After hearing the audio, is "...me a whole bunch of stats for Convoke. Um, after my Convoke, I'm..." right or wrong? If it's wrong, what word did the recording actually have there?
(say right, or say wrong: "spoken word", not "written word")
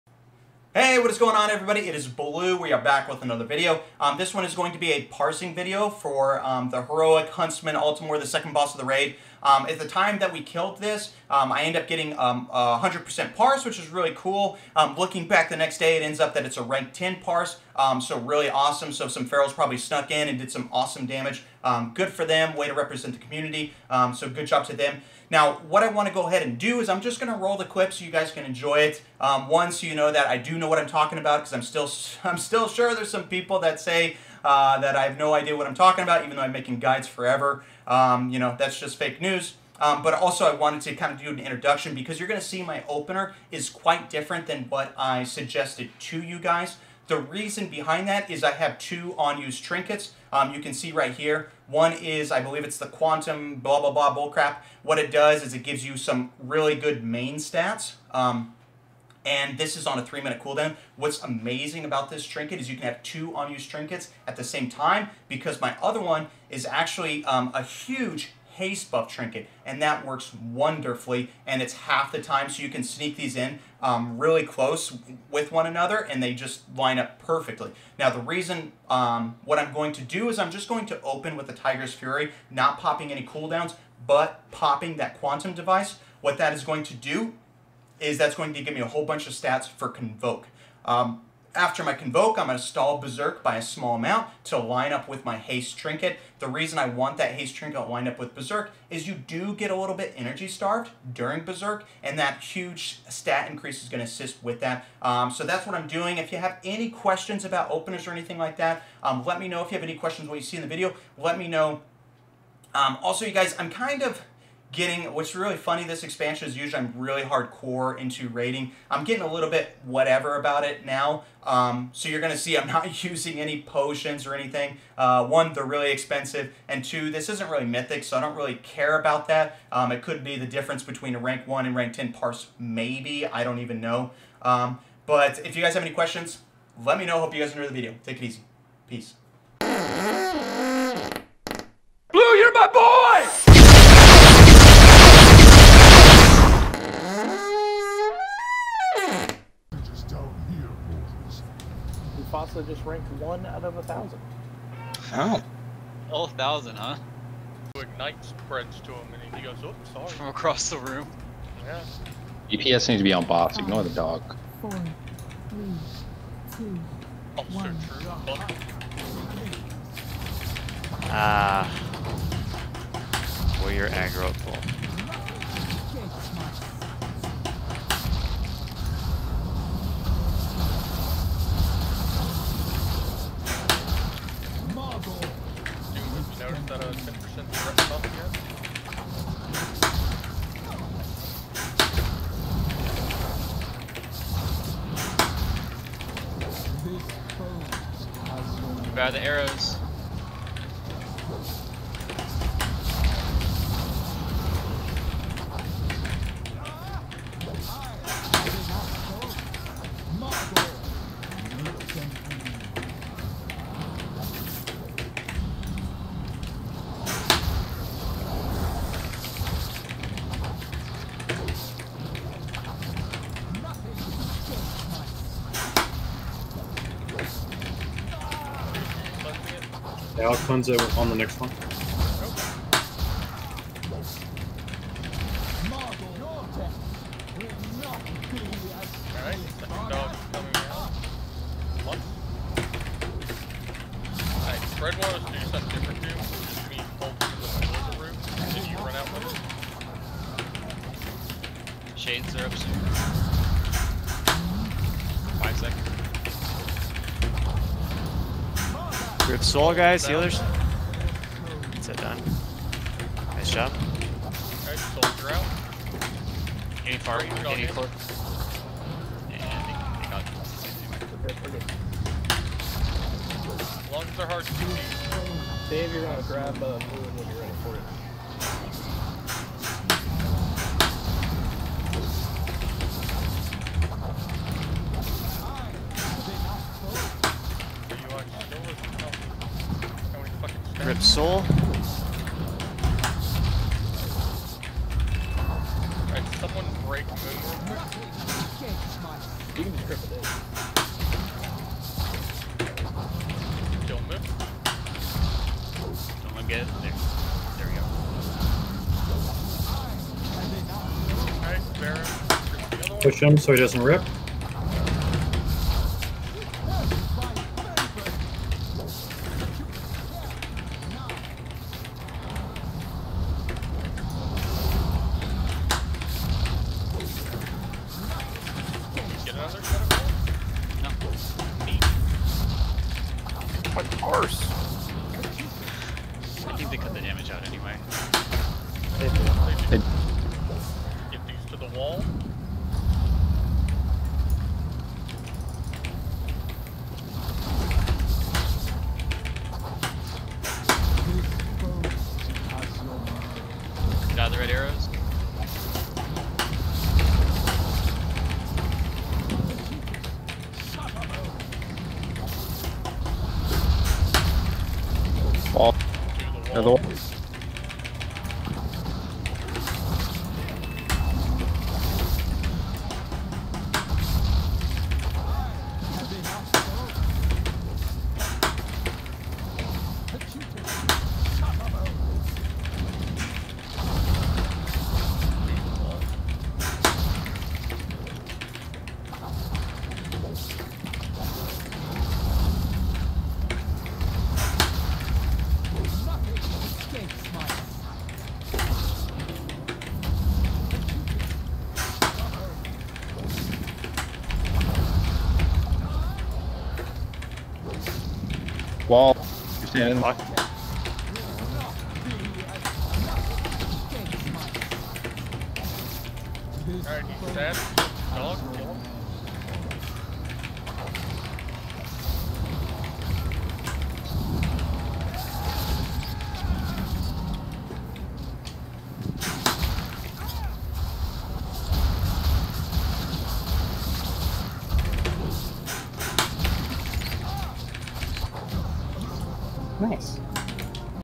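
right.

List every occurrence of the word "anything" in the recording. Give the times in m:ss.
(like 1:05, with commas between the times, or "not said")
1:48, 2:04.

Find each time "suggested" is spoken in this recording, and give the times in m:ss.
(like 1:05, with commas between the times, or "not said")
0:45.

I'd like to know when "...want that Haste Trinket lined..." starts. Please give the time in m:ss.
1:36.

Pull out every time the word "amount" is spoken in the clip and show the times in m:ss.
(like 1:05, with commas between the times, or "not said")
1:33.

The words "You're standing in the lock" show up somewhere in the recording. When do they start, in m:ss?
6:49.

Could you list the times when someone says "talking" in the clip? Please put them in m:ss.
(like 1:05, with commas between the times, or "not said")
0:30, 0:35.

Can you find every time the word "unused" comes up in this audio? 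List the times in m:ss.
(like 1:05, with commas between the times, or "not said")
0:49, 1:03.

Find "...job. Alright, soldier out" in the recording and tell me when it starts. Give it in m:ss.
4:23.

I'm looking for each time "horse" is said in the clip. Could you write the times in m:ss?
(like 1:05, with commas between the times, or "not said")
5:34.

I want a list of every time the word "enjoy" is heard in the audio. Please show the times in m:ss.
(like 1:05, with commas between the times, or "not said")
0:28, 2:17.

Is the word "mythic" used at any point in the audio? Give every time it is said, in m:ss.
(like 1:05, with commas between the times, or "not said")
2:07.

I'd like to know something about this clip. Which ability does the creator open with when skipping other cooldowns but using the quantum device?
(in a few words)
Tiger's Fury.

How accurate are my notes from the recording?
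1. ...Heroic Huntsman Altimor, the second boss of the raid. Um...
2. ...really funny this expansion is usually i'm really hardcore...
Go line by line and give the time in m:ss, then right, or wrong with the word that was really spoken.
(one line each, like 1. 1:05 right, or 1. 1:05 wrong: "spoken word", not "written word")
1. 0:06 right
2. 1:55 right.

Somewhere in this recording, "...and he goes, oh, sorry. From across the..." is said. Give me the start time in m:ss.
2:39.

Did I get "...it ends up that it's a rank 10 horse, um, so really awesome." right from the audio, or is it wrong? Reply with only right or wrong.
wrong.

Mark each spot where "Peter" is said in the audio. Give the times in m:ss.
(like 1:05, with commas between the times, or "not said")
not said.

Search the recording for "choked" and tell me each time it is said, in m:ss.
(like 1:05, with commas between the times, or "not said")
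not said.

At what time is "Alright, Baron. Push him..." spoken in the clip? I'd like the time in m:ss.
5:11.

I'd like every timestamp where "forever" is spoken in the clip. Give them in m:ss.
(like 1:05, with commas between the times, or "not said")
0:37.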